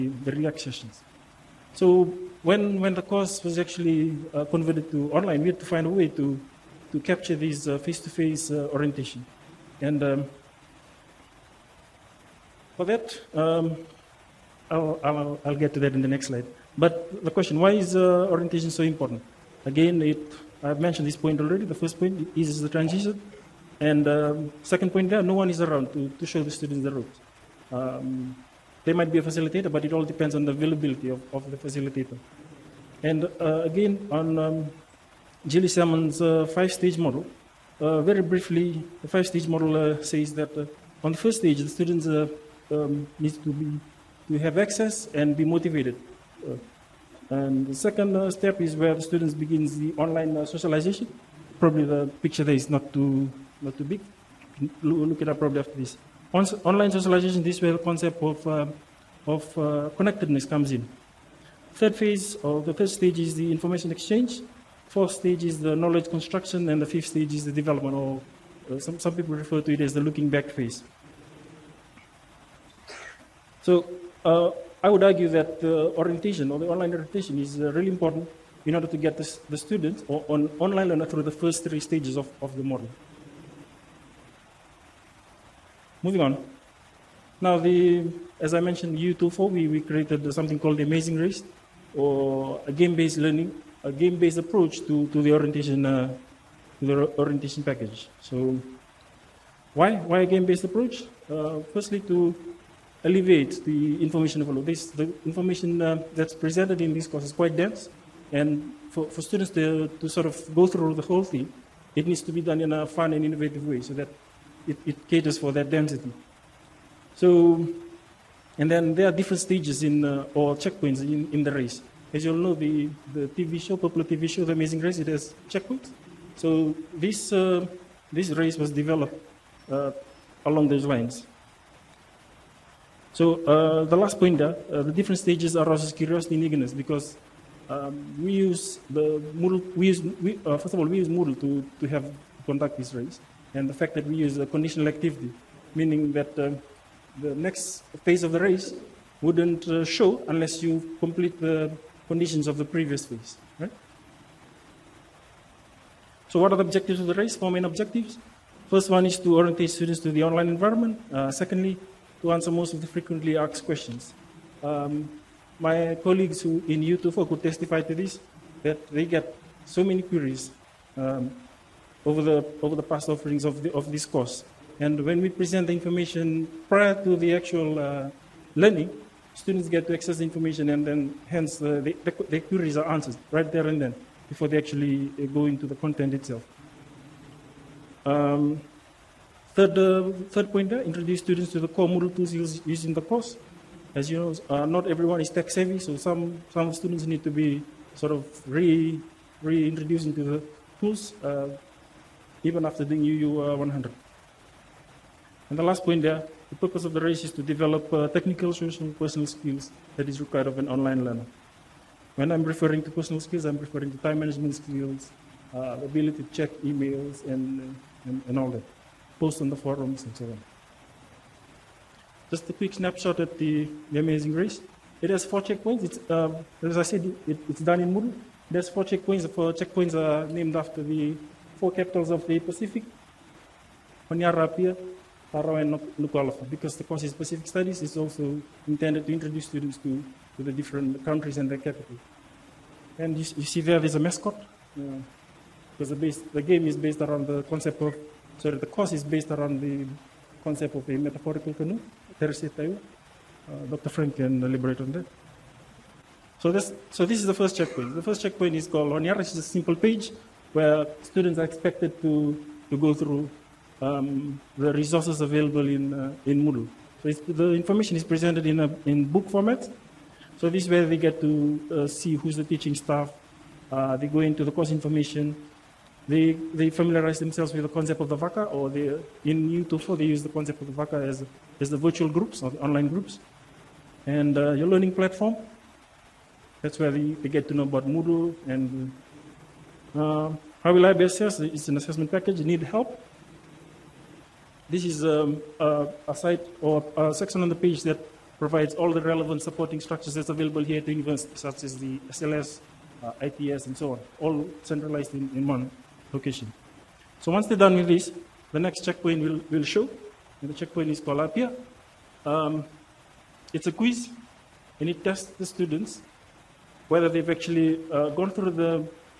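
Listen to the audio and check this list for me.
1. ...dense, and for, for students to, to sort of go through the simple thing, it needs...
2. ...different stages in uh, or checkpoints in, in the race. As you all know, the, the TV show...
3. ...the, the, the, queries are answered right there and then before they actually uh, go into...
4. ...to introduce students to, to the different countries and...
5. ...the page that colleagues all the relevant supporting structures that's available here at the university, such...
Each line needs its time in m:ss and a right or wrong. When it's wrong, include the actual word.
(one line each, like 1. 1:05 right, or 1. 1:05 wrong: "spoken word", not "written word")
1. 1:47 wrong: "whole", not "simple"
2. 1:59 right
3. 3:01 right
4. 3:59 right
5. 4:57 wrong: "provides", not "colleagues".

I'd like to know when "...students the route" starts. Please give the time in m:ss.
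0:26.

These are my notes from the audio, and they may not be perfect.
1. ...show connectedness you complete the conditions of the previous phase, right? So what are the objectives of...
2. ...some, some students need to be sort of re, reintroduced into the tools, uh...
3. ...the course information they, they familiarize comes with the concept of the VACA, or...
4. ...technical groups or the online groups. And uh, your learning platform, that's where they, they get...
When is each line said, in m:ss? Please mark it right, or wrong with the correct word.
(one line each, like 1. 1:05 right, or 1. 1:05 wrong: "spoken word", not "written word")
1. 2:29 wrong: "unless", not "connectedness"
2. 3:15 right
3. 4:34 wrong: "themselves", not "comes"
4. 4:41 wrong: "virtual", not "technical".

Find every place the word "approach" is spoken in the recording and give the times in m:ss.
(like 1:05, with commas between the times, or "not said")
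1:34, 1:40.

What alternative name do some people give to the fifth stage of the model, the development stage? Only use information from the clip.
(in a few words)
looking back phase.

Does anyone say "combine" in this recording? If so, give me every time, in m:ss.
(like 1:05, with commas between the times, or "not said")
not said.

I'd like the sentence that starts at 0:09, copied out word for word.
And um, for that, um, I'll, I'll, I'll, get to that in the next slide.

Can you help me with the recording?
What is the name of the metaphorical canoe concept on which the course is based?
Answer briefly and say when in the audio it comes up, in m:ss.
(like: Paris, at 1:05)
Teresi Taiwa, at 4:12.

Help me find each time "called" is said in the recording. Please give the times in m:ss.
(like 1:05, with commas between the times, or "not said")
1:30, 4:18, 5:10.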